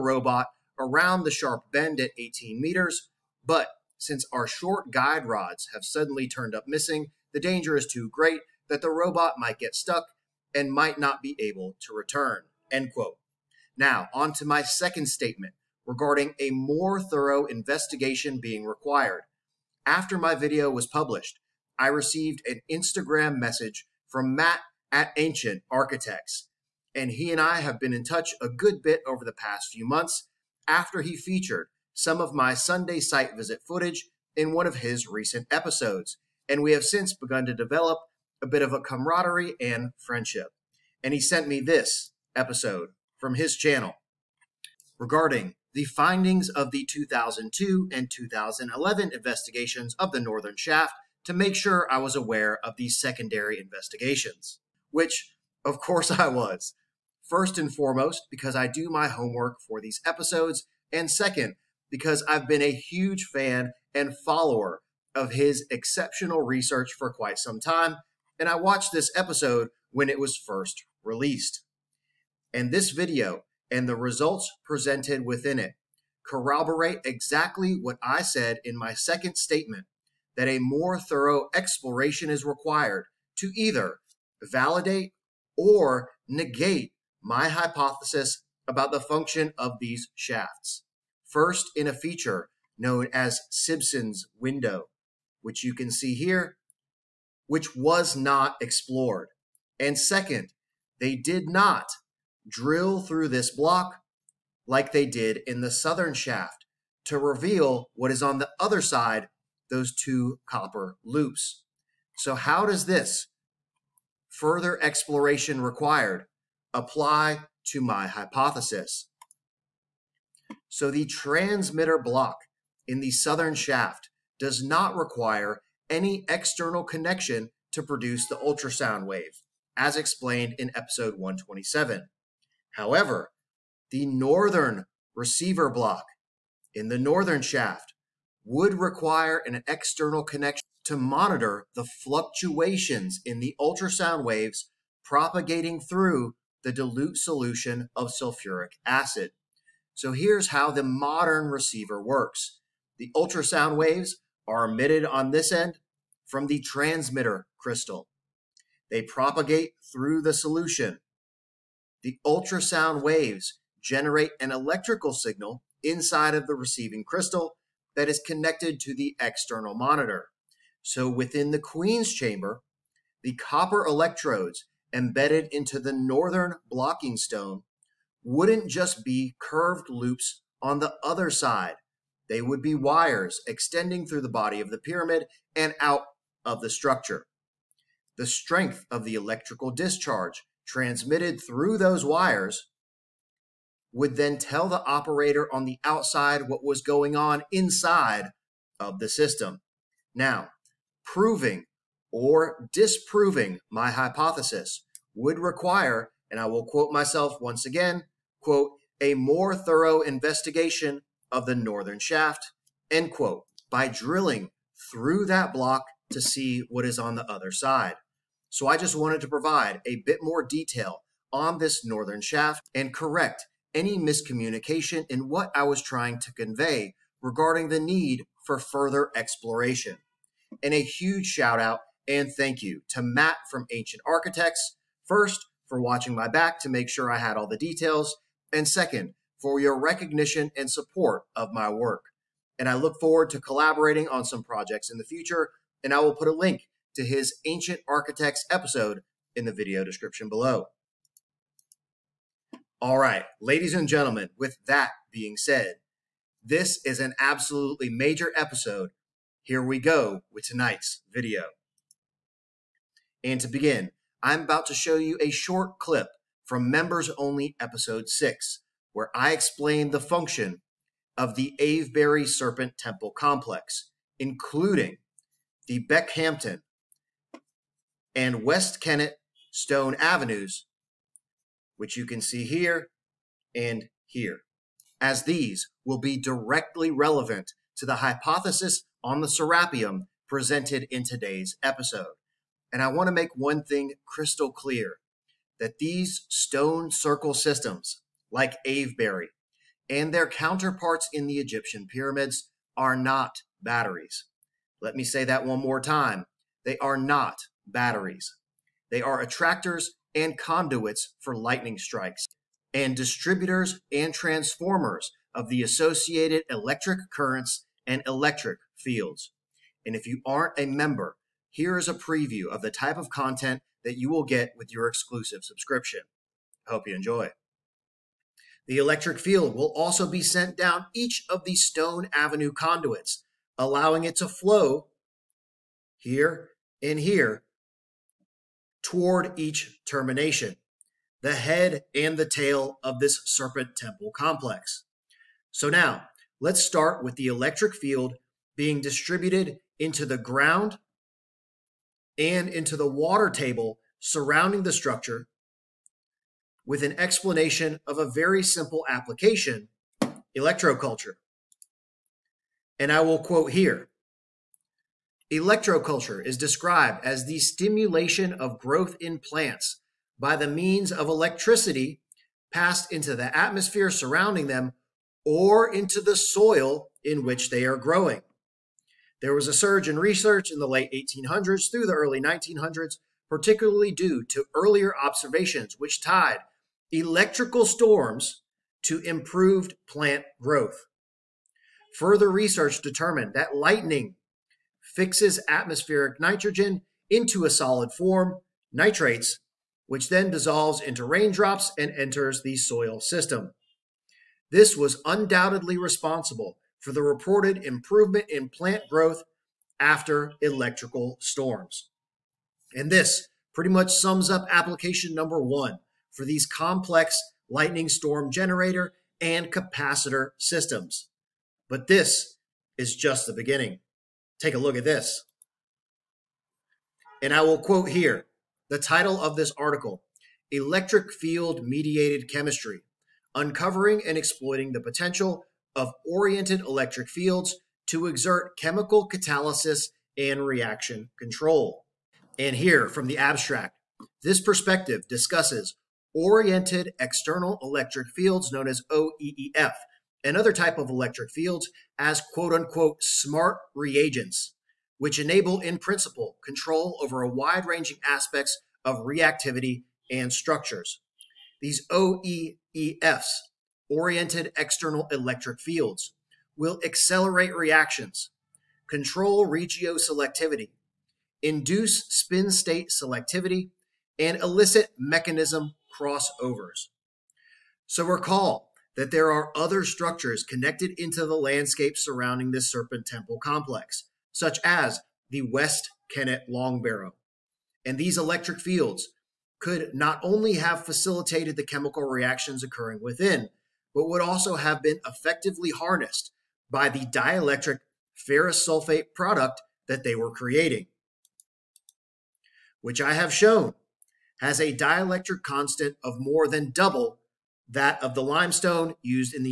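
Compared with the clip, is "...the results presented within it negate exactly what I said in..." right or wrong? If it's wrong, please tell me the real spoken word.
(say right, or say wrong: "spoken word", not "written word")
wrong: "corroborate", not "negate".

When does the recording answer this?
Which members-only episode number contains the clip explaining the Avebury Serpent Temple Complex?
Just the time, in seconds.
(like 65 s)
266 s.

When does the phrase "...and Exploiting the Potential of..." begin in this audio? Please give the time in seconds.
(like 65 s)
434 s.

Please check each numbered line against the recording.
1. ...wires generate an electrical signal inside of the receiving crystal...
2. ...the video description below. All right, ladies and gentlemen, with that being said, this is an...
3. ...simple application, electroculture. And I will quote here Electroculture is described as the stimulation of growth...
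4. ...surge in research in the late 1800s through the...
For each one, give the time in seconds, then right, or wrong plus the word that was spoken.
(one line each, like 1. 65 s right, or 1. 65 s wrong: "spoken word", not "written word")
1. 163 s wrong: "waves", not "wires"
2. 249 s right
3. 358 s right
4. 379 s right.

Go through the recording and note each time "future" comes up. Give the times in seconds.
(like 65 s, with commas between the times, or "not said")
245 s.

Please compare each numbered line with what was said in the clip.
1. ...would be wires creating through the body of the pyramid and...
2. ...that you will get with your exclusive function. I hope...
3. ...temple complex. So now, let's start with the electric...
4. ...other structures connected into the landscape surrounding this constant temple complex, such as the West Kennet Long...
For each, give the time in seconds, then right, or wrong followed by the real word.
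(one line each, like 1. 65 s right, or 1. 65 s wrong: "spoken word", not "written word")
1. 182 s wrong: "extending", not "creating"
2. 323 s wrong: "subscription", not "function"
3. 343 s right
4. 479 s wrong: "serpent", not "constant".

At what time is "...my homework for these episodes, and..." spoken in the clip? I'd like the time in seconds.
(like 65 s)
58 s.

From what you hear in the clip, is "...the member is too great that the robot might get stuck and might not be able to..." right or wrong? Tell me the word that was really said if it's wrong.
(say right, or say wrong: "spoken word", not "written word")
wrong: "danger", not "member".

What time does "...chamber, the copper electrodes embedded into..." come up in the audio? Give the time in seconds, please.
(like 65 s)
172 s.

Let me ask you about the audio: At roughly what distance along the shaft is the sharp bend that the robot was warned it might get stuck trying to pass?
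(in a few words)
18 meters.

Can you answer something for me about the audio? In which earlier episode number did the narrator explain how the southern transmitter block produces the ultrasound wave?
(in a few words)
127.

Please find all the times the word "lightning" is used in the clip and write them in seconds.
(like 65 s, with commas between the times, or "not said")
311 s, 393 s, 417 s.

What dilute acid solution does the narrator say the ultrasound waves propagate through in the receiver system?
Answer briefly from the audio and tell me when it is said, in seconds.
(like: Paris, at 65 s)
sulfuric acid, at 148 s.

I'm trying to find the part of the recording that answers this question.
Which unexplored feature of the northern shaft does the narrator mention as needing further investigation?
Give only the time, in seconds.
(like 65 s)
93 s.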